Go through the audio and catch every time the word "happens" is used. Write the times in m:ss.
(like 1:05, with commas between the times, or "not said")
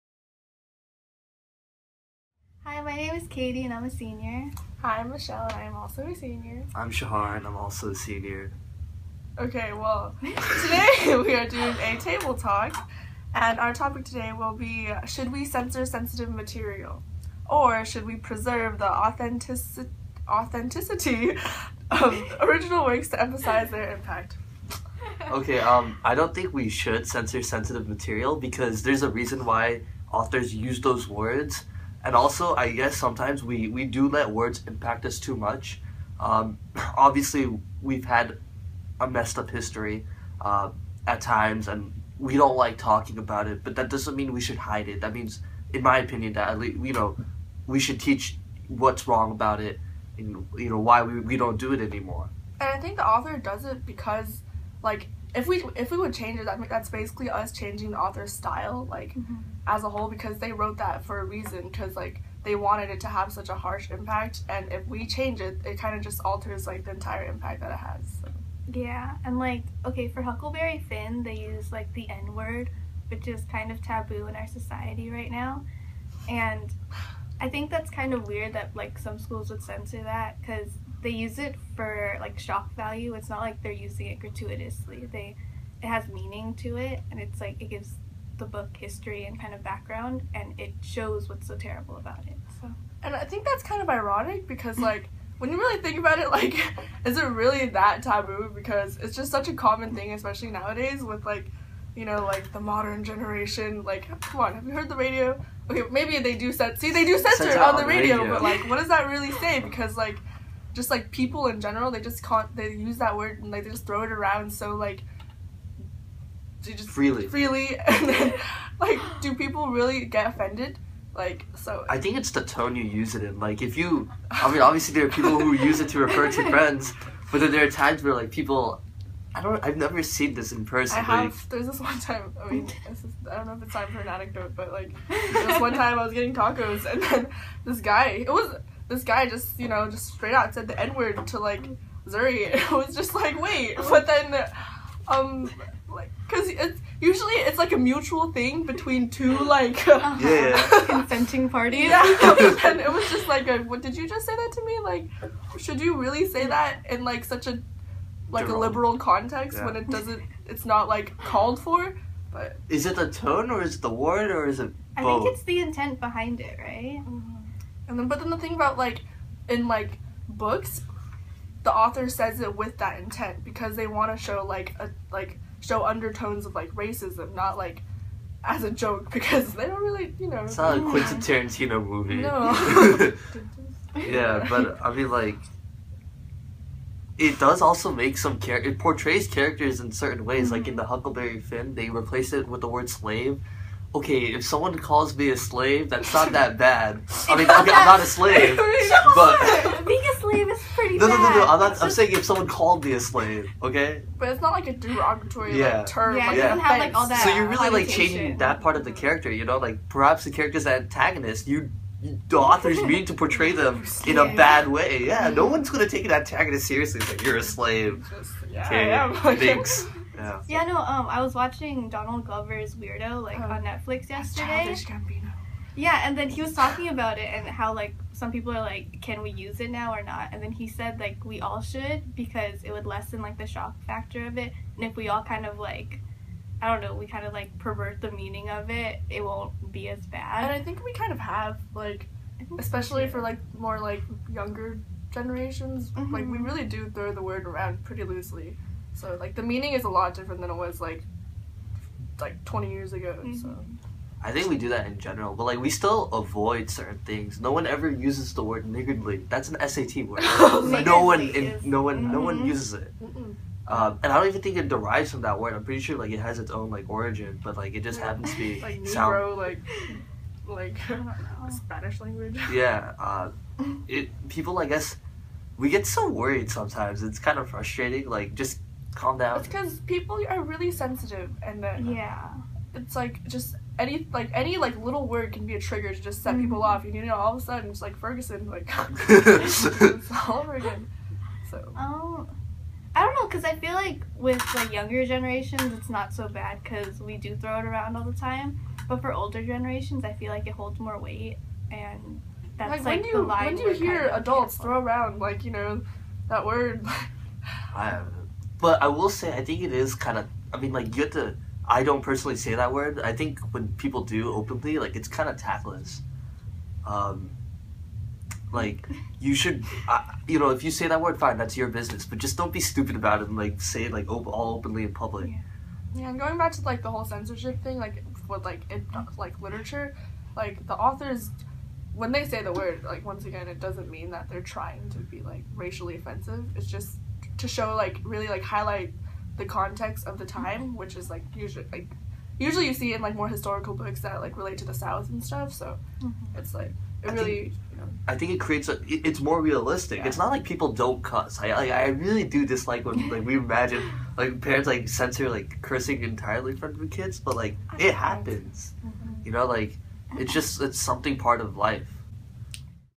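4:28, 5:57.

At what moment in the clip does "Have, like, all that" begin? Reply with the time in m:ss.
3:26.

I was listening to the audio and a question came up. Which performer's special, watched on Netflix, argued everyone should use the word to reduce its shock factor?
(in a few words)
Donald Glover.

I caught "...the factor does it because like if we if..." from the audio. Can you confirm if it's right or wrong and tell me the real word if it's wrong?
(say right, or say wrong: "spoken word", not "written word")
wrong: "author", not "factor".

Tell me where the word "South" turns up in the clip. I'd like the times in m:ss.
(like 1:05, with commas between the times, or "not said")
5:44.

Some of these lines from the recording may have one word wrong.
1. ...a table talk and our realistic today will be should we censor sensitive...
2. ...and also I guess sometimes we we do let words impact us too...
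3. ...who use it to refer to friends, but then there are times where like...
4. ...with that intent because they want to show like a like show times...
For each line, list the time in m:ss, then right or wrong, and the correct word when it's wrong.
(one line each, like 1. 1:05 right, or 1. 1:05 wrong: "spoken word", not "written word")
1. 0:11 wrong: "topic", not "realistic"
2. 0:32 right
3. 2:05 right
4. 2:52 wrong: "undertones", not "times".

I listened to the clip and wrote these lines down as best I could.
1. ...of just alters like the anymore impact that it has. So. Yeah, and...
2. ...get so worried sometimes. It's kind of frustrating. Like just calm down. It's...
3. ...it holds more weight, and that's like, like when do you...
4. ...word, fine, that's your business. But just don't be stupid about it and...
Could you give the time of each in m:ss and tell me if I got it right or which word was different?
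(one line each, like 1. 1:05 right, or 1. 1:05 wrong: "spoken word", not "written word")
1. 1:05 wrong: "entire", not "anymore"
2. 4:35 right
3. 5:00 right
4. 5:21 right.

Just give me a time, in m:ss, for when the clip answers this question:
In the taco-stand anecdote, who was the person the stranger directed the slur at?
2:22.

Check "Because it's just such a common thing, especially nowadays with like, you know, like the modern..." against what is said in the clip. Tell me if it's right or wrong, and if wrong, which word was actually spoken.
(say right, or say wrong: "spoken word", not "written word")
right.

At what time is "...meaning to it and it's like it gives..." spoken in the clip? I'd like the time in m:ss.
1:26.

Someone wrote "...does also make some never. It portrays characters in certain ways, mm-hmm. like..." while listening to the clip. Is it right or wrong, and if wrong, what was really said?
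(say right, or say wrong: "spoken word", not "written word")
wrong: "character", not "never".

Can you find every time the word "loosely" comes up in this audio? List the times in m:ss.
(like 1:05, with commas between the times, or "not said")
4:08.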